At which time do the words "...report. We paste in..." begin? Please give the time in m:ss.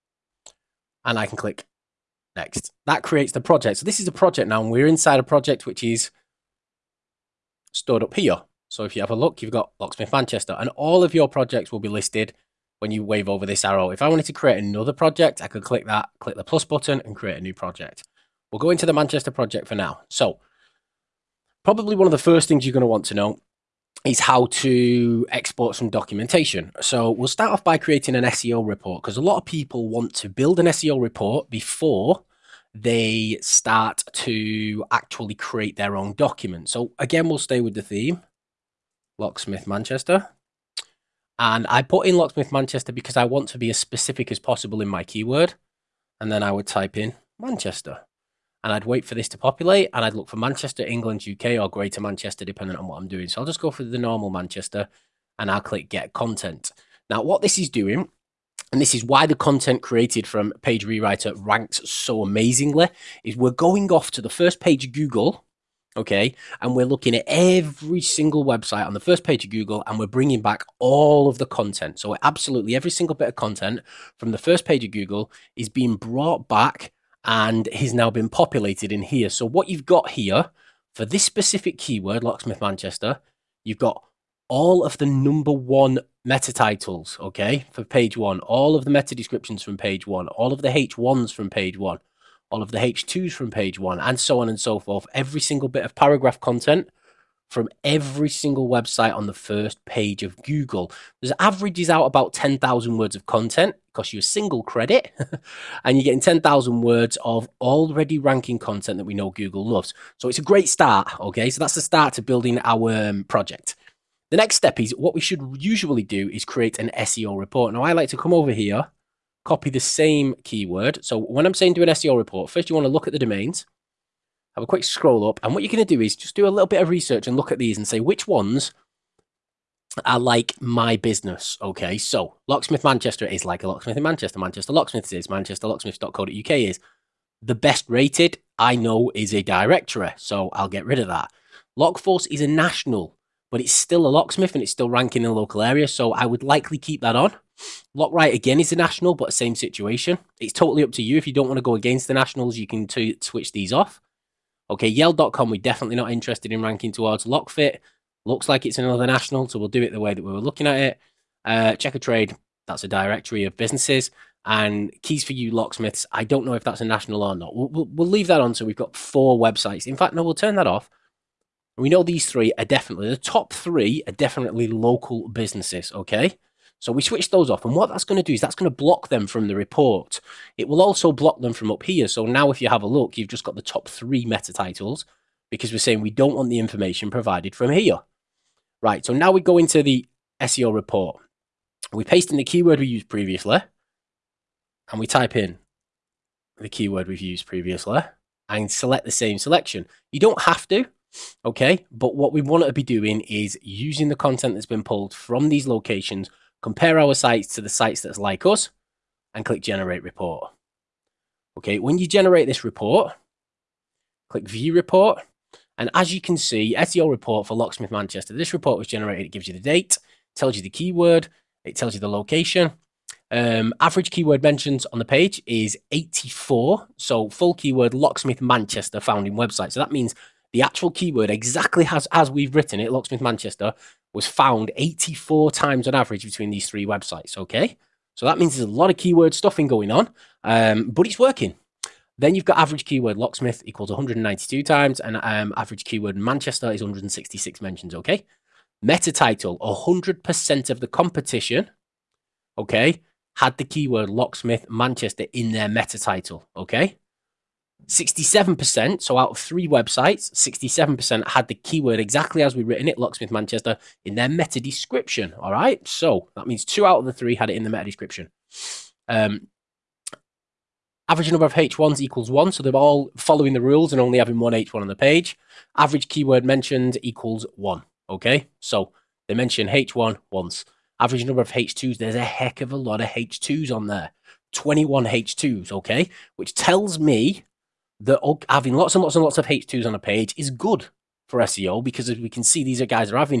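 3:10.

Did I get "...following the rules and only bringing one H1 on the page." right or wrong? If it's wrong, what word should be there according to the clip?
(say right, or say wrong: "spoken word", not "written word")
wrong: "having", not "bringing".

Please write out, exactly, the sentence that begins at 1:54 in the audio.
The next step is what we should usually do is create an SEO report.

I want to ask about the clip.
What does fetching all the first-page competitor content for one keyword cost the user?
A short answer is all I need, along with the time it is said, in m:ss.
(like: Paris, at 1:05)
a single credit, at 1:44.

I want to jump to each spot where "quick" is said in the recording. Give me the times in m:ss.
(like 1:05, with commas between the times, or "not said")
2:04.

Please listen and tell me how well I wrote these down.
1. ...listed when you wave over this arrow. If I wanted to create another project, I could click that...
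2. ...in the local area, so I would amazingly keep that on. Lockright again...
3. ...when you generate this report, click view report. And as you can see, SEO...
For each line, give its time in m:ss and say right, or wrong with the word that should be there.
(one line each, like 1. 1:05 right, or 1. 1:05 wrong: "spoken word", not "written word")
1. 0:11 right
2. 2:25 wrong: "likely", not "amazingly"
3. 3:31 right.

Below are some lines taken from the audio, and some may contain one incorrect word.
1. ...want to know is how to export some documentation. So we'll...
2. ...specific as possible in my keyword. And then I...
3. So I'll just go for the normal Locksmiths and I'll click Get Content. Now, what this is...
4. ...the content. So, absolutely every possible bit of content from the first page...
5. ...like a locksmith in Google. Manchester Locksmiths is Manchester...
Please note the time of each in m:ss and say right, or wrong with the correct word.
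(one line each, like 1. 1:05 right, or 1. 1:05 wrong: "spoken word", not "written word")
1. 0:22 right
2. 0:43 right
3. 0:53 wrong: "Manchester", not "Locksmiths"
4. 1:11 wrong: "single", not "possible"
5. 2:13 wrong: "Manchester", not "Google".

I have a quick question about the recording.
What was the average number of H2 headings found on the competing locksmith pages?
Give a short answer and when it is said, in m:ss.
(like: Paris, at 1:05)
21, at 4:44.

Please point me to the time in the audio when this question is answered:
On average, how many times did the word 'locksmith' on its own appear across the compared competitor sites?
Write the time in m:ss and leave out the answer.
4:03.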